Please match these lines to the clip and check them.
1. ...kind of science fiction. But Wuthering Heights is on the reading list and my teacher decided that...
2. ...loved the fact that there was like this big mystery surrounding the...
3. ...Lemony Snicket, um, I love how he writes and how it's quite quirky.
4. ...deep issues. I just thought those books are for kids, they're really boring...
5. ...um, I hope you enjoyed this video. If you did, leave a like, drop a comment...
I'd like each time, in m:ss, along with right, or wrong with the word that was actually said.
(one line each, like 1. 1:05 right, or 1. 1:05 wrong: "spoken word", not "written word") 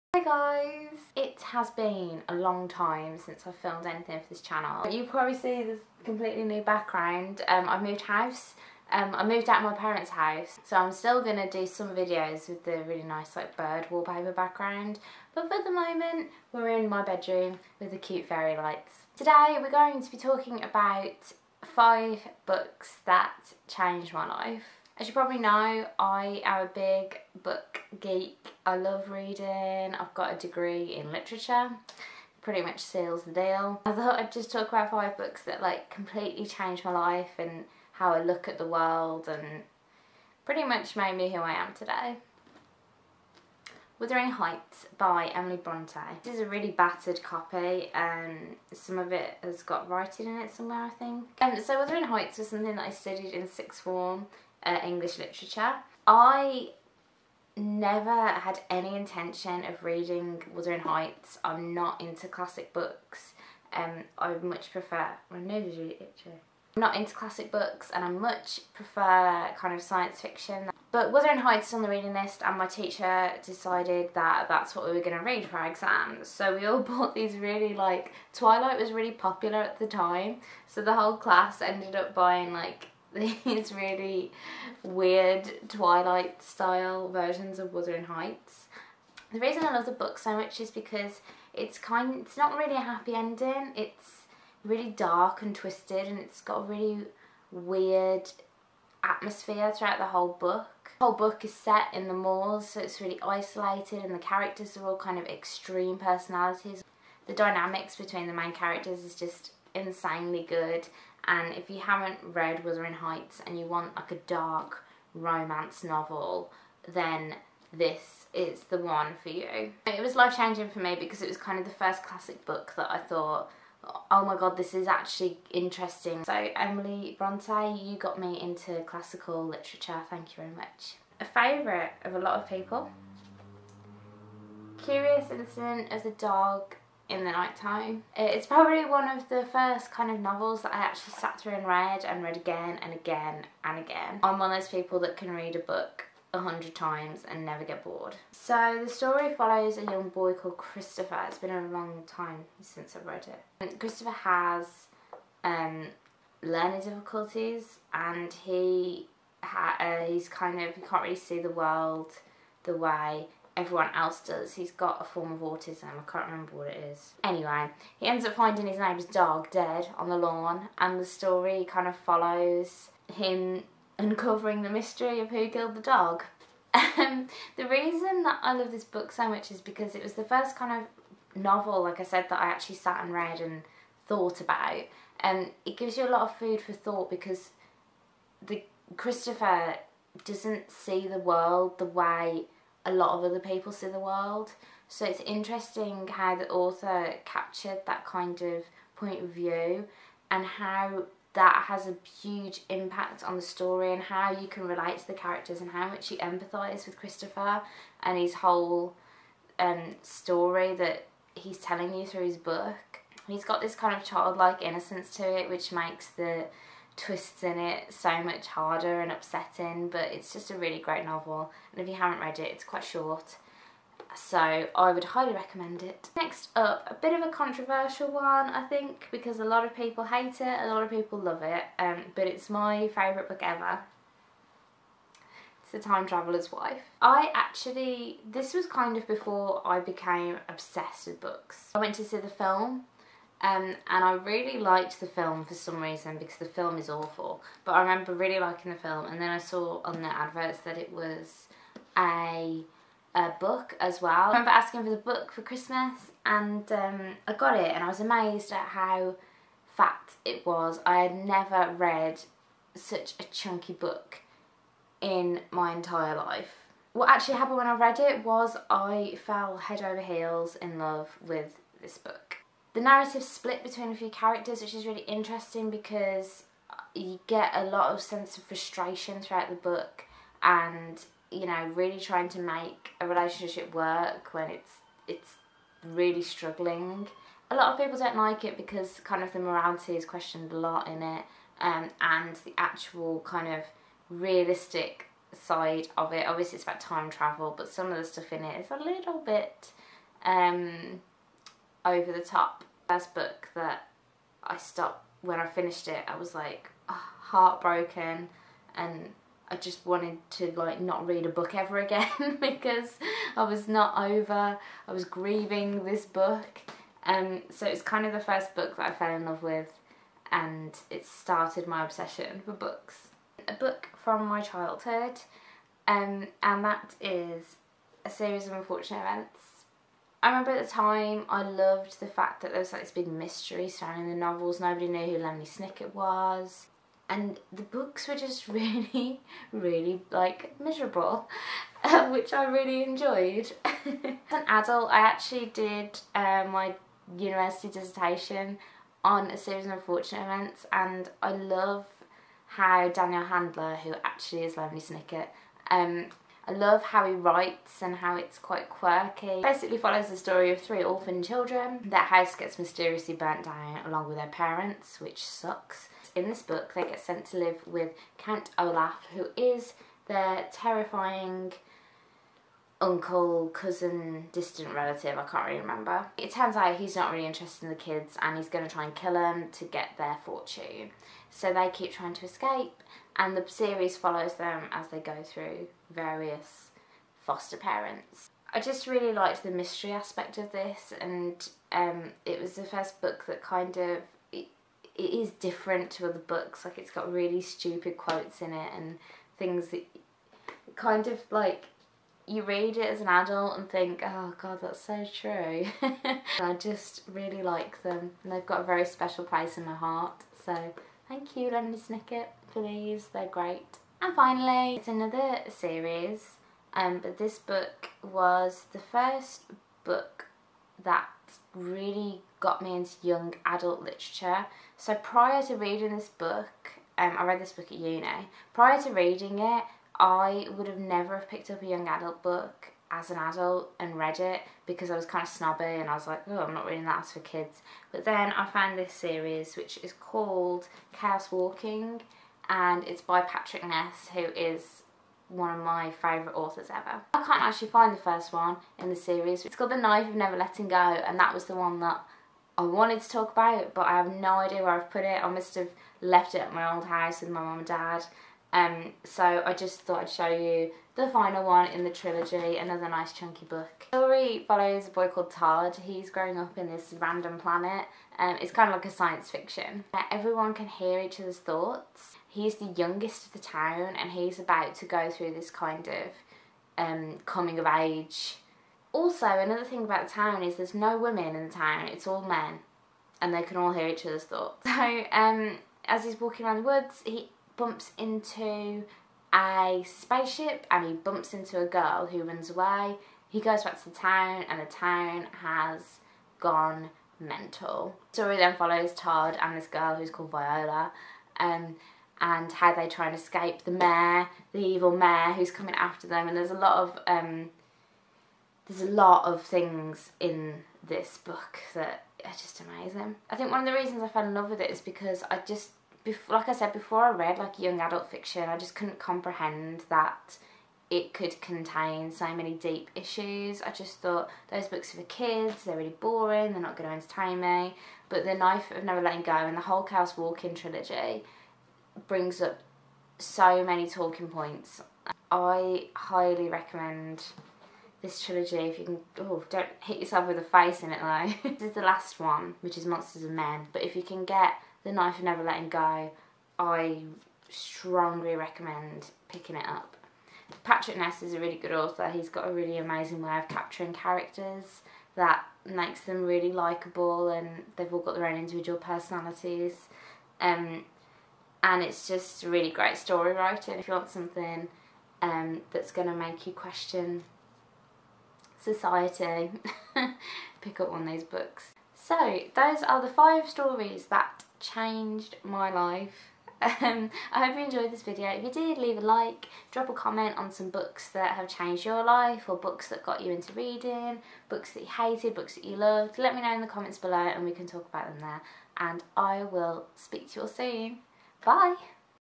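1. 1:09 right
2. 5:31 right
3. 5:54 right
4. 8:42 right
5. 9:36 right.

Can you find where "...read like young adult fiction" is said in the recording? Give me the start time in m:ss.
8:37.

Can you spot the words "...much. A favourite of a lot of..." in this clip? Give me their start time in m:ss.
2:10.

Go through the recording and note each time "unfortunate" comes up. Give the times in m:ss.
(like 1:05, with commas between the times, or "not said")
5:28, 5:49.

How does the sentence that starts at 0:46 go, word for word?
This is a really battered copy and um, some of it has got writing in it somewhere I think.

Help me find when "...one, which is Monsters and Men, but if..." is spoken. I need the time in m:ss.
9:02.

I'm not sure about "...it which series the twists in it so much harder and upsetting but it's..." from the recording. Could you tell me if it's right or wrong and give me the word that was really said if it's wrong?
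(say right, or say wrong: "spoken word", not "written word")
wrong: "makes", not "series".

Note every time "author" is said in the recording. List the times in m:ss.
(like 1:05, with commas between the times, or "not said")
3:16, 7:26, 9:11.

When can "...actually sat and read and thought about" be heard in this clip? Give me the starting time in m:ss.
3:02.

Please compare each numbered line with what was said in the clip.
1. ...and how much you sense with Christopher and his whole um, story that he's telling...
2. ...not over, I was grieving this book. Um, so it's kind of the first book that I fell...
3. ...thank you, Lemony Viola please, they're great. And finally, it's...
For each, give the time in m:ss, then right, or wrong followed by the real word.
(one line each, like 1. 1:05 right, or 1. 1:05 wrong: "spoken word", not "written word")
1. 3:25 wrong: "empathise", not "sense"
2. 5:13 right
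3. 6:51 wrong: "Snicket", not "Viola".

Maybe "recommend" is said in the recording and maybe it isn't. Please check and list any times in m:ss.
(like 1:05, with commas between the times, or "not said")
3:45, 8:56, 9:08.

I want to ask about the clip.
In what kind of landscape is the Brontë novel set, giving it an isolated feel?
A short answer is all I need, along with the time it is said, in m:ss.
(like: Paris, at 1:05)
the moors, at 1:42.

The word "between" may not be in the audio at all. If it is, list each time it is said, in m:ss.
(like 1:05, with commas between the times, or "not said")
1:47, 4:33.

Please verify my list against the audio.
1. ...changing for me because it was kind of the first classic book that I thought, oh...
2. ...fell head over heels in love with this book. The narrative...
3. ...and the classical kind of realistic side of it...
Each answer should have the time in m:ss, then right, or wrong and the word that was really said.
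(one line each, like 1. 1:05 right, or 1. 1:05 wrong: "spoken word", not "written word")
1. 2:00 right
2. 4:29 right
3. 4:52 wrong: "actual", not "classical".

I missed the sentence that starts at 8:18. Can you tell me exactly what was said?
Story then follows Todd and this girl who's called Viola.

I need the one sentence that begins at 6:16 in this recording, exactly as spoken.
It turns out he's not really interested in the kids and he's going to try and kill them to get their fortune.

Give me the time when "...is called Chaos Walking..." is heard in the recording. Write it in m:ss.
7:19.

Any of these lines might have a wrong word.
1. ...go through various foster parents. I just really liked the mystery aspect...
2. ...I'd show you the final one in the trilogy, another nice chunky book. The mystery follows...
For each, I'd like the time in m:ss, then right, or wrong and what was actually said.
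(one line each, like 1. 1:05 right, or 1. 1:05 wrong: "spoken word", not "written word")
1. 6:24 right
2. 7:40 wrong: "story", not "mystery".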